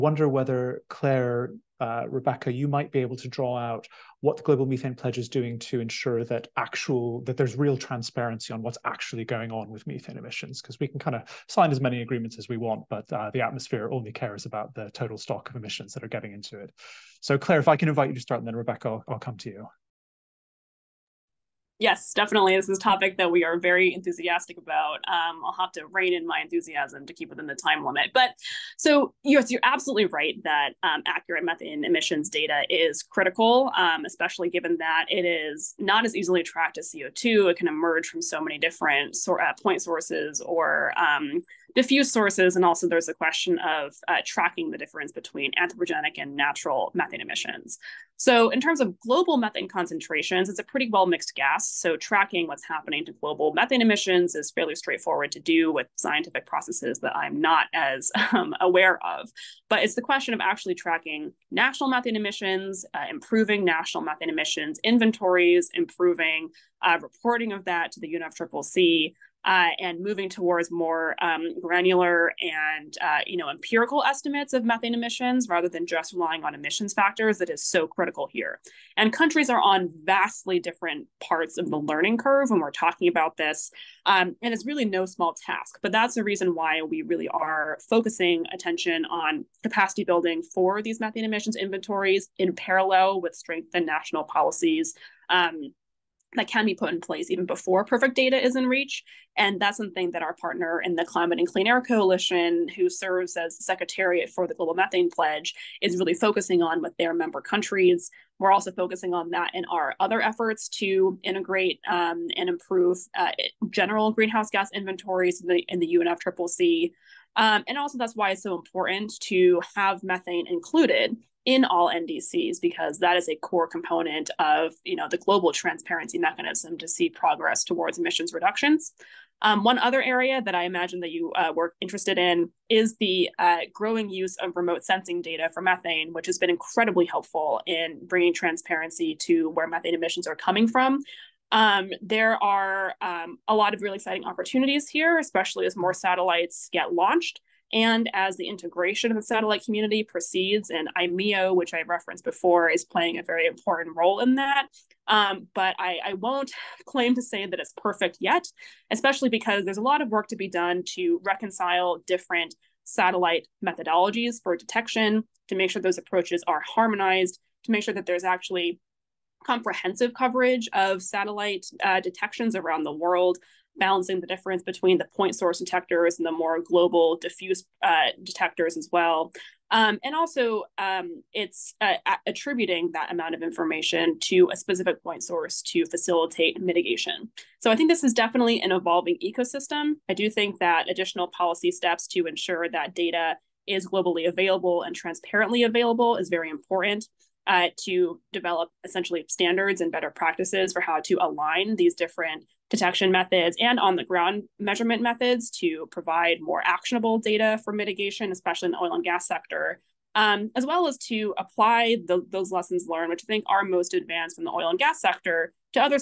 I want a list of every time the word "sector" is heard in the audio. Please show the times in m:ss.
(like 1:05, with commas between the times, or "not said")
3:29, 3:34.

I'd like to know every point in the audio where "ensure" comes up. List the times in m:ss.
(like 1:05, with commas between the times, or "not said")
0:05, 3:12.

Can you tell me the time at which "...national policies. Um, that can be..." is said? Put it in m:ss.
1:33.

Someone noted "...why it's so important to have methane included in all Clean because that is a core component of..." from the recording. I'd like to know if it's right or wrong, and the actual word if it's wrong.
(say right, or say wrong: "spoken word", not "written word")
wrong: "NDCs", not "Clean".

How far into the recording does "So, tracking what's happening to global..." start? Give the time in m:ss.
0:51.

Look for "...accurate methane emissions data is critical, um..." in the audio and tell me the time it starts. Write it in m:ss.
0:31.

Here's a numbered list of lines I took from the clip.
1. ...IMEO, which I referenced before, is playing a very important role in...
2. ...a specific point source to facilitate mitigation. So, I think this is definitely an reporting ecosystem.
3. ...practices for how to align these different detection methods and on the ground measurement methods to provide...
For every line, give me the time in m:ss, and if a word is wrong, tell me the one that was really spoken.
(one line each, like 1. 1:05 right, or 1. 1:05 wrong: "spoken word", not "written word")
1. 2:30 right
2. 3:04 wrong: "evolving", not "reporting"
3. 3:20 right.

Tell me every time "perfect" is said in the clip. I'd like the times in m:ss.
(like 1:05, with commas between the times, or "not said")
1:37, 2:37.